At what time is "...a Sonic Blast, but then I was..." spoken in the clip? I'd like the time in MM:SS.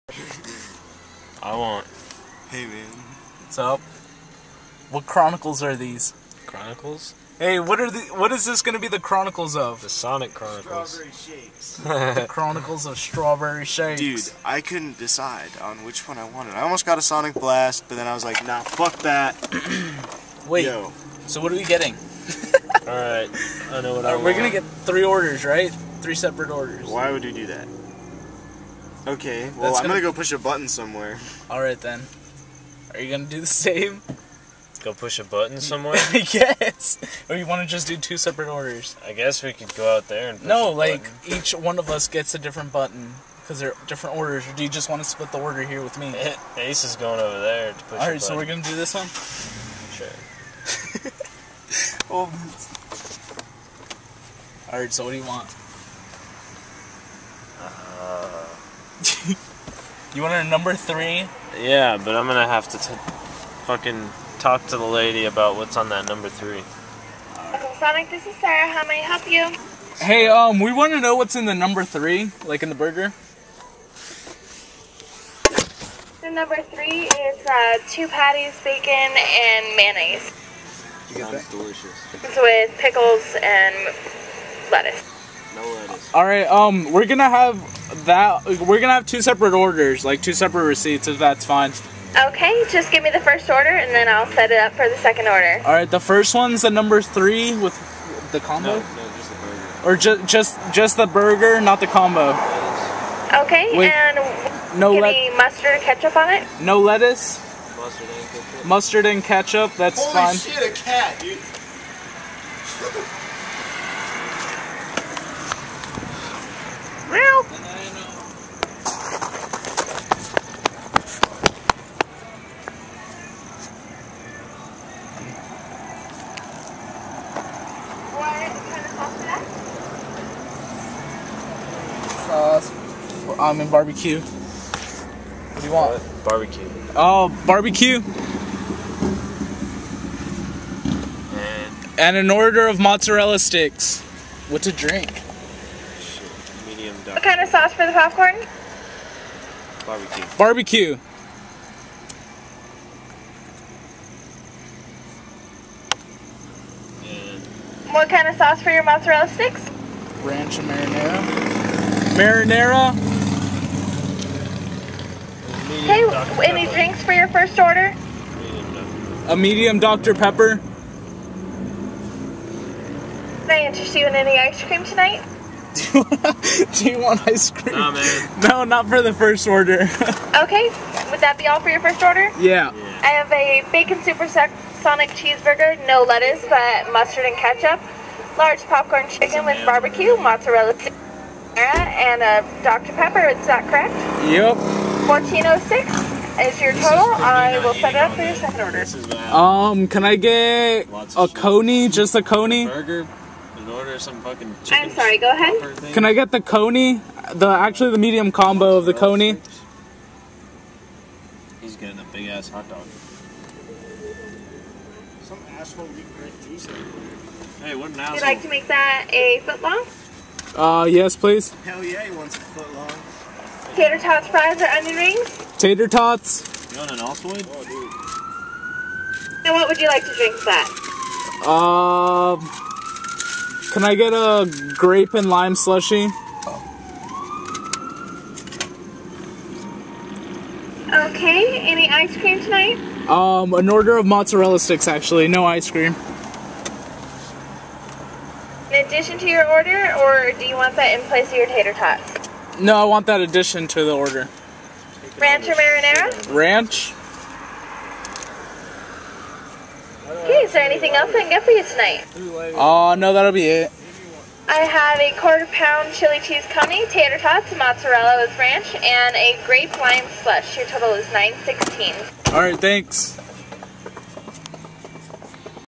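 00:16.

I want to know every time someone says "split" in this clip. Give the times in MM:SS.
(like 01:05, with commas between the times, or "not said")
00:45.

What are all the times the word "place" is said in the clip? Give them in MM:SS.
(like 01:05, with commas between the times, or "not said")
04:11.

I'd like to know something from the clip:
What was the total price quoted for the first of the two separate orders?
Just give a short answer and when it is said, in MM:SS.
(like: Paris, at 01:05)
$14.06, at 03:15.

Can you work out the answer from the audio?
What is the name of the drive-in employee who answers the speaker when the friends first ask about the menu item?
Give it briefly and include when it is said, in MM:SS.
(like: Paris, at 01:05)
Sarah, at 01:08.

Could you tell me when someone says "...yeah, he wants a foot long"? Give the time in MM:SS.
03:41.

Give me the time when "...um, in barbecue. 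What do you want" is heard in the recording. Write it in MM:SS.
02:13.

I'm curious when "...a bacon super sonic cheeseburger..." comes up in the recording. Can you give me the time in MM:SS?
03:03.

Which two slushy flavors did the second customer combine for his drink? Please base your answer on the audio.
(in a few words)
Grape and lime.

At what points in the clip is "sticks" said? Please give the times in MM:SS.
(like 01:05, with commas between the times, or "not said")
02:23, 02:39, 04:04.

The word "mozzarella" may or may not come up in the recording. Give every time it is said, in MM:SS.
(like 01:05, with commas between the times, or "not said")
02:22, 02:38, 03:10, 04:04, 04:27.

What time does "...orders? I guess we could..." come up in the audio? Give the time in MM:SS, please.
00:38.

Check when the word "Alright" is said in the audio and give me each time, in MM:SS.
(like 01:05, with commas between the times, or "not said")
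00:31, 00:47, 00:54.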